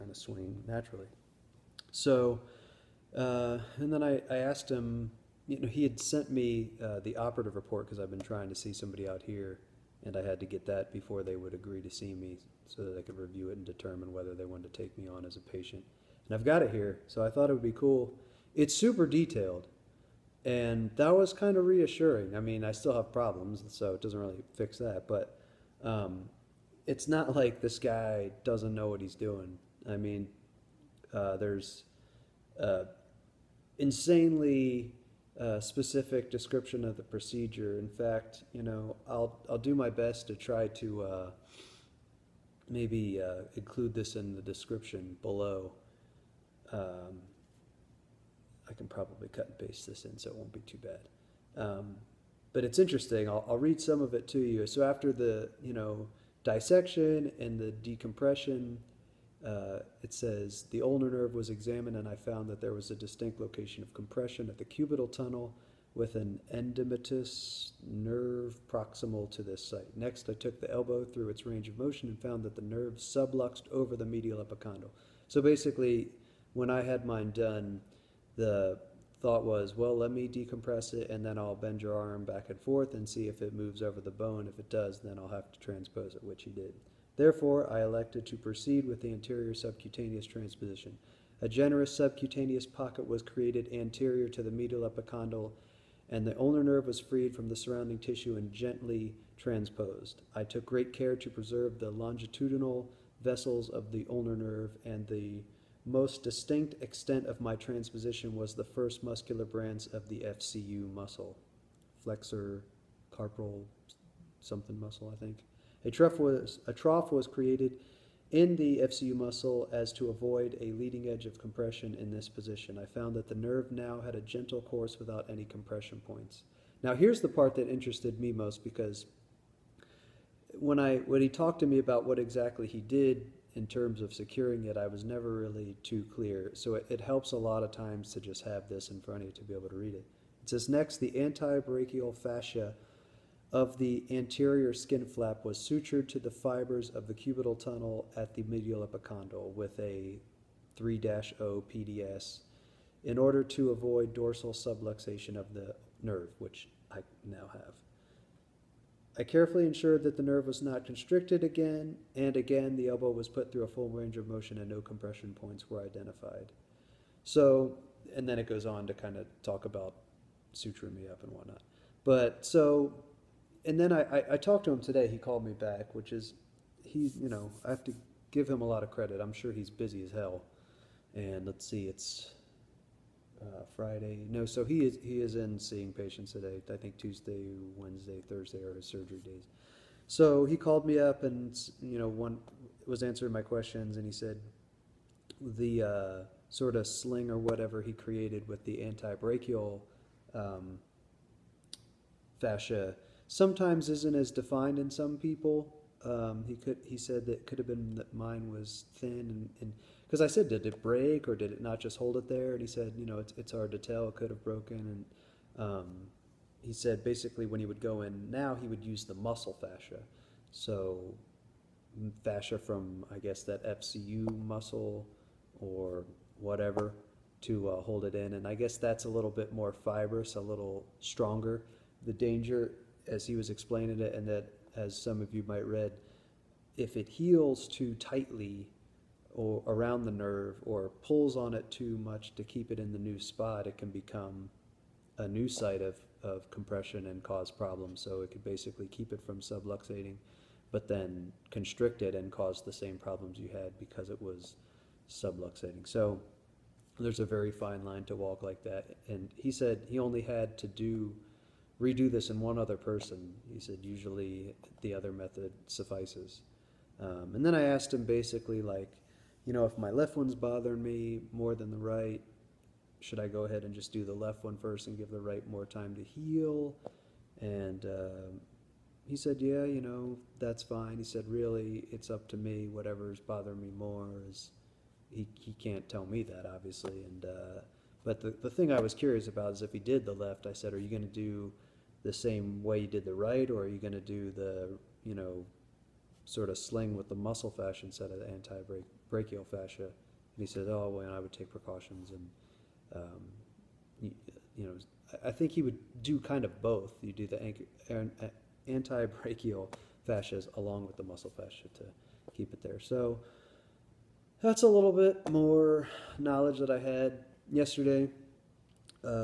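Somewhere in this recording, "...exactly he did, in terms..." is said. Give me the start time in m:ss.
2:12.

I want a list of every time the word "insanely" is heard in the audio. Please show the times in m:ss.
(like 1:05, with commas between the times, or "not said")
0:33.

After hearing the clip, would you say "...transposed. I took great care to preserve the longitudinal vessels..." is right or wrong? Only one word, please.
right.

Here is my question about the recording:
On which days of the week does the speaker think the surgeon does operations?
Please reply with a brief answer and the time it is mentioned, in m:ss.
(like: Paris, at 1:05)
Tuesday, Wednesday, Thursday, at 3:06.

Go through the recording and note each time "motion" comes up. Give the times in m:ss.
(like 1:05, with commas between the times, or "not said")
1:11, 2:44.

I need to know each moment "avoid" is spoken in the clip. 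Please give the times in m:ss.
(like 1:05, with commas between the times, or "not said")
2:00, 2:33.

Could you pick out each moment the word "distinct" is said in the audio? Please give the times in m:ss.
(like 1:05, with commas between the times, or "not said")
1:02, 1:46.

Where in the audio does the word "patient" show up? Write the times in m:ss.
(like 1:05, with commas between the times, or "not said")
0:15, 3:05.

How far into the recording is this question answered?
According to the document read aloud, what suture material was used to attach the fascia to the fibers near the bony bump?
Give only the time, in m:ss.
2:30.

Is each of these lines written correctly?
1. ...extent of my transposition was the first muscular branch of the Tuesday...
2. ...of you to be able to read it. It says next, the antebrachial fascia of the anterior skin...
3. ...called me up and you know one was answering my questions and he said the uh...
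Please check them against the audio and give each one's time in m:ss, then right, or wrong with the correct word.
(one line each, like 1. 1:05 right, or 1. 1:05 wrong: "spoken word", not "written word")
1. 1:46 wrong: "FCU", not "Tuesday"
2. 2:19 right
3. 3:10 right.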